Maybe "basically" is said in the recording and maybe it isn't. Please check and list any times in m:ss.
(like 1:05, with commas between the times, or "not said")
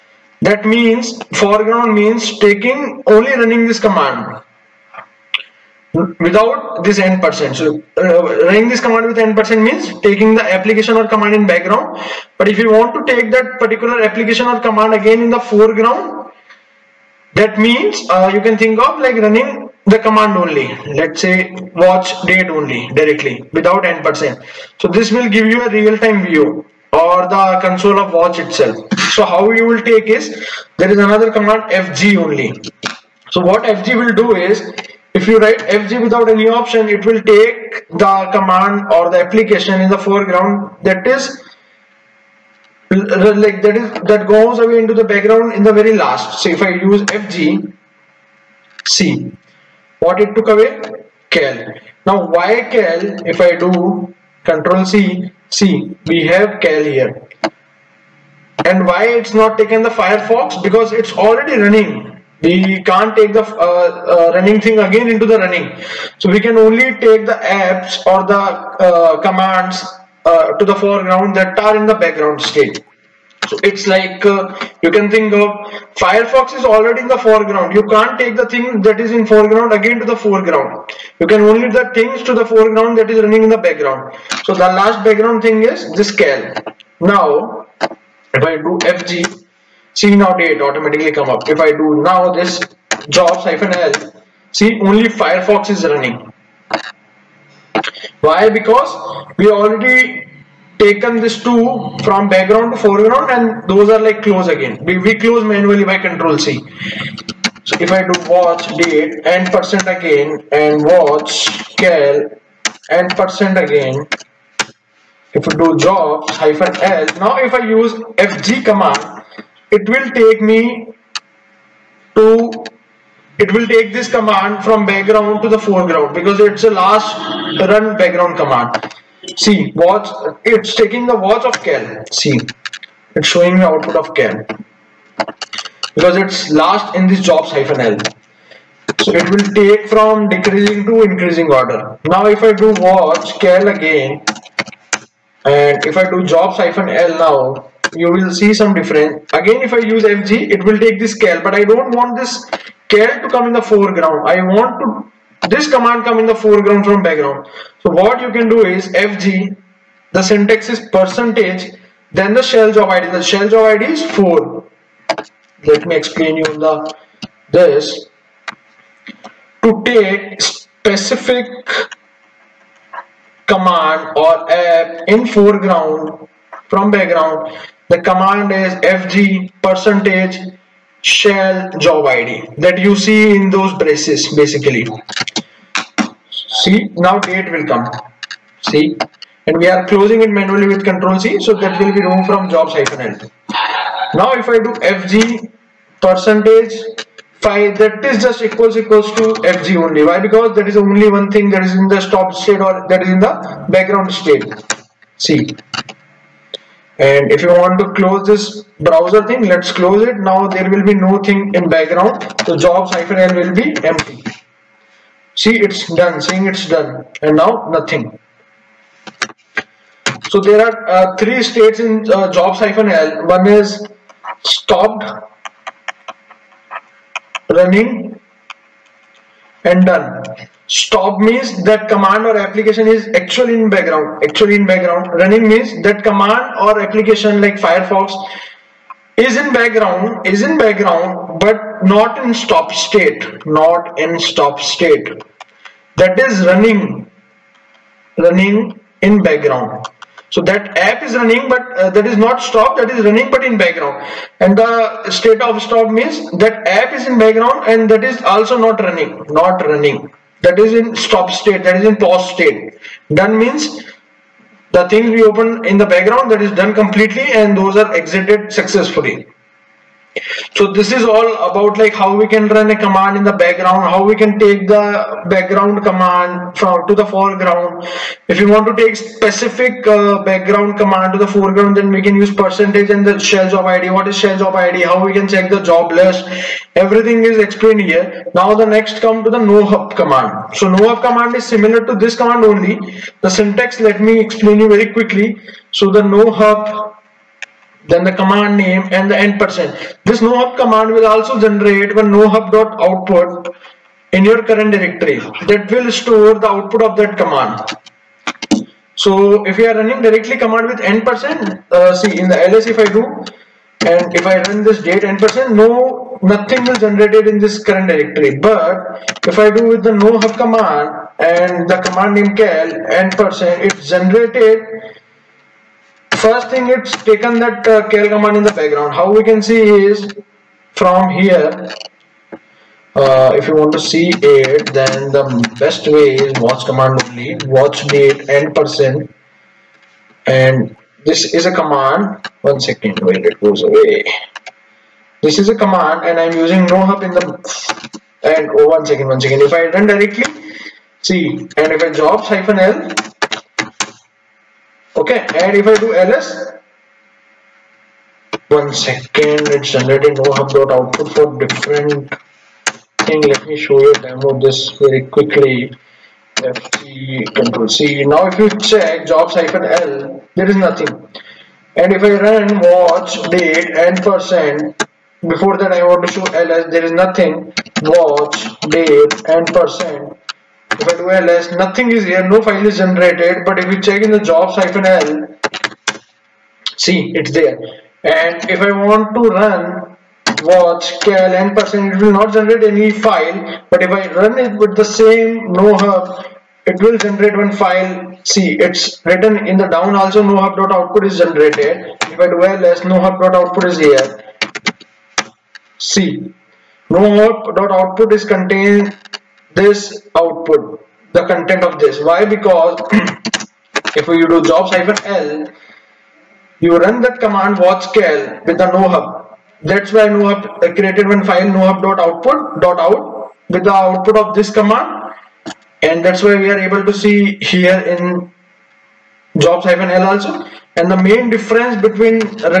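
3:04.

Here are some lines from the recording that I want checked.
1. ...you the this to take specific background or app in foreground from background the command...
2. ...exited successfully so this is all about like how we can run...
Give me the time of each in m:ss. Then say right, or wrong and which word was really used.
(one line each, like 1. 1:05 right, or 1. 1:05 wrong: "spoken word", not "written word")
1. 2:46 wrong: "command", not "background"
2. 4:27 right.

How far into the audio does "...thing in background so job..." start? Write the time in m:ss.
3:31.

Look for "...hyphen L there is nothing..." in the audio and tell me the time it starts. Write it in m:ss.
6:09.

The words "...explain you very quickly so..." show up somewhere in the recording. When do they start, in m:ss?
4:54.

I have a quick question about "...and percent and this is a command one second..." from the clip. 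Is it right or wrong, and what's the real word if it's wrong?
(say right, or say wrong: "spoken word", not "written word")
right.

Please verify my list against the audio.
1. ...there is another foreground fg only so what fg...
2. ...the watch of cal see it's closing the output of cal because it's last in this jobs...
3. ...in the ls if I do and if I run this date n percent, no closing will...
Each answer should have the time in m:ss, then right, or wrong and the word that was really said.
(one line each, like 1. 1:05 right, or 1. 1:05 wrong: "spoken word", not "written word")
1. 0:30 wrong: "command", not "foreground"
2. 2:11 wrong: "showing", not "closing"
3. 5:12 wrong: "nothing", not "closing".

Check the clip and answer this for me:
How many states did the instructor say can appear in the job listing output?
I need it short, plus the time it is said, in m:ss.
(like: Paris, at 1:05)
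three, at 3:41.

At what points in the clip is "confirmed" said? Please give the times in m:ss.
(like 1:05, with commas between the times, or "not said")
not said.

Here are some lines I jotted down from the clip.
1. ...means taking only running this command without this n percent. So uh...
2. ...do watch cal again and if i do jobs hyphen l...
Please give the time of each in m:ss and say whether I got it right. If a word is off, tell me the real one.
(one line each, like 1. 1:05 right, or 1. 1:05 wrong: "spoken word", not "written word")
1. 0:01 right
2. 2:22 right.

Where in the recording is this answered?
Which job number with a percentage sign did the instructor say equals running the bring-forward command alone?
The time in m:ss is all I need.
3:14.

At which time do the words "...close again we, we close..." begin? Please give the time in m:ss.
1:44.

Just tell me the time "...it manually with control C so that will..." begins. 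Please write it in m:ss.
3:10.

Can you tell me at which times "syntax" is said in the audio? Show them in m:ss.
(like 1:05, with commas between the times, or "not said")
2:40, 4:53.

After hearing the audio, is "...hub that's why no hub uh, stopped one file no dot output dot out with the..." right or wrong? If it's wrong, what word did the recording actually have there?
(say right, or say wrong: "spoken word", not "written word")
wrong: "created", not "stopped".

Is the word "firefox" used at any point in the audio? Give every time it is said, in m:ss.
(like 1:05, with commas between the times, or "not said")
0:59, 1:15, 1:35, 3:57.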